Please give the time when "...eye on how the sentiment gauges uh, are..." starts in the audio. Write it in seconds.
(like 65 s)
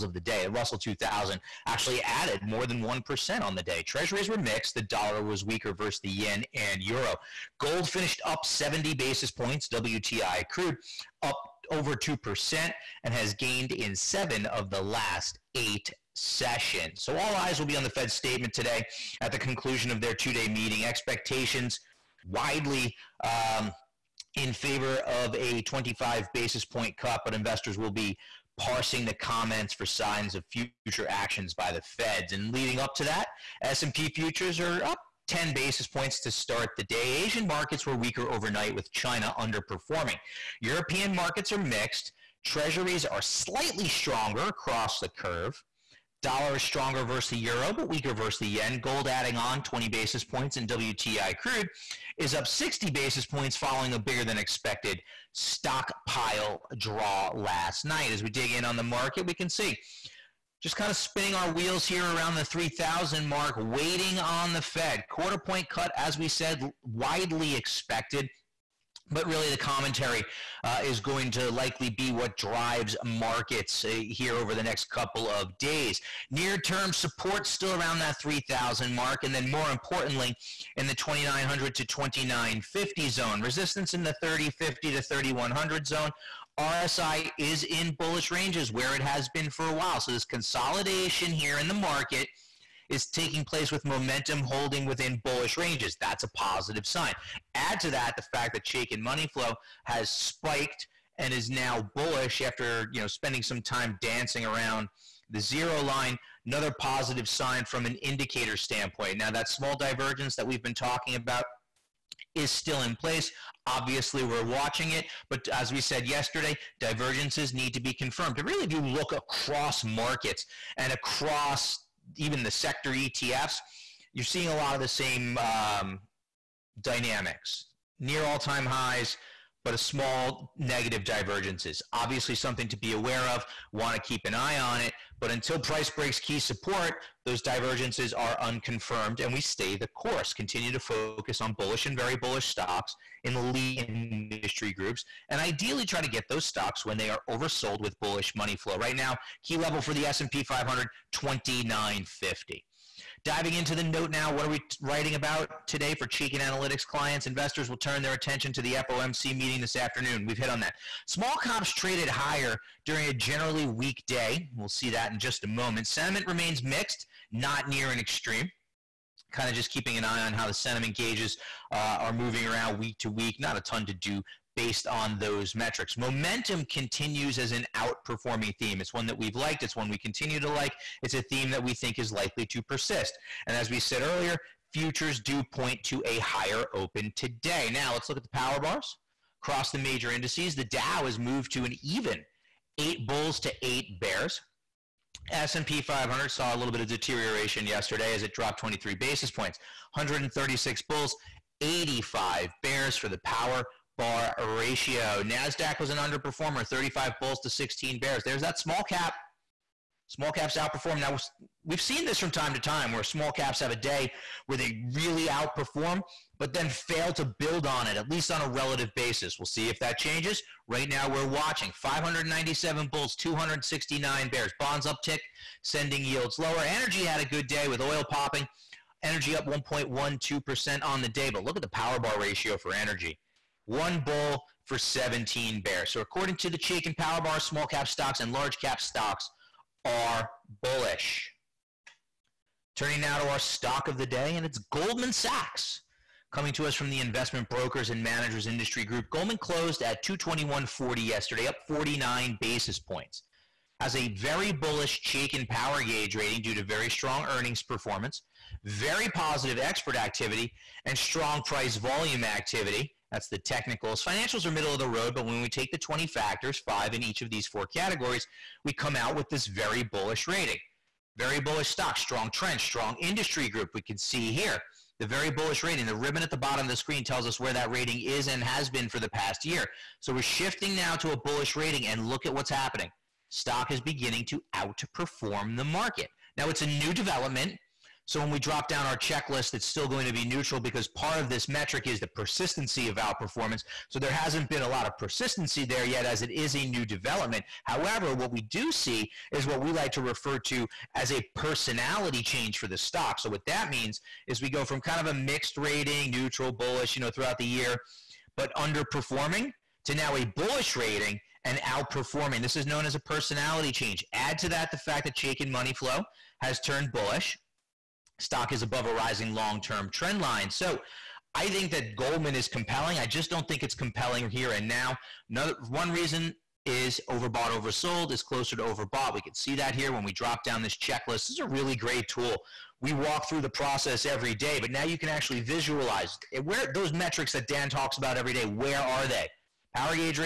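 170 s.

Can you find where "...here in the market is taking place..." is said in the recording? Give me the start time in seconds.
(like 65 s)
91 s.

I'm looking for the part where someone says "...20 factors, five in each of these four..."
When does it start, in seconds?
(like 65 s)
265 s.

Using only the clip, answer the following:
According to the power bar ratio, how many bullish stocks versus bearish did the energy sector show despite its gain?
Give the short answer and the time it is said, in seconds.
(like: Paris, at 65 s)
1 bull to 17 bears, at 233 s.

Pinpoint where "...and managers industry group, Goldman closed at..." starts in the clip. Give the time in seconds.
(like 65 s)
247 s.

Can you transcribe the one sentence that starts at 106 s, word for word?
Another positive sign from an indicator standpoint.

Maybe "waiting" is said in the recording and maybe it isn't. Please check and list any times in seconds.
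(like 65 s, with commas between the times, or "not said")
63 s.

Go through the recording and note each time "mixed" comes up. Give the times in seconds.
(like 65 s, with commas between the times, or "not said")
4 s, 41 s, 166 s, 305 s.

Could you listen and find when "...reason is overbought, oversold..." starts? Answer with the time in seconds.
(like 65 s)
325 s.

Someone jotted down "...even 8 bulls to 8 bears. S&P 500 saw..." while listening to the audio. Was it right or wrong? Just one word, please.
right.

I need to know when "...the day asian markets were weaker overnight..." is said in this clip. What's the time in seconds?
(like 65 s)
36 s.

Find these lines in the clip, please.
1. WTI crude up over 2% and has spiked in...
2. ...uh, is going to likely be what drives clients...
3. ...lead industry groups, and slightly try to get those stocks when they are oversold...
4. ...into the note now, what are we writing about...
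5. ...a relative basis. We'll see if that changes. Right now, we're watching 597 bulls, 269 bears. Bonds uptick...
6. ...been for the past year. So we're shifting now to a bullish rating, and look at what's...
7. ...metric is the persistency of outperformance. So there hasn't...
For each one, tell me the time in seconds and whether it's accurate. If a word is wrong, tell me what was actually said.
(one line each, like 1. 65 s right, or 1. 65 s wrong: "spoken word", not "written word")
1. 9 s wrong: "gained", not "spiked"
2. 70 s wrong: "markets", not "clients"
3. 143 s wrong: "ideally", not "slightly"
4. 153 s right
5. 218 s right
6. 278 s right
7. 291 s right.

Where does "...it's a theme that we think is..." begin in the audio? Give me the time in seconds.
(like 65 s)
181 s.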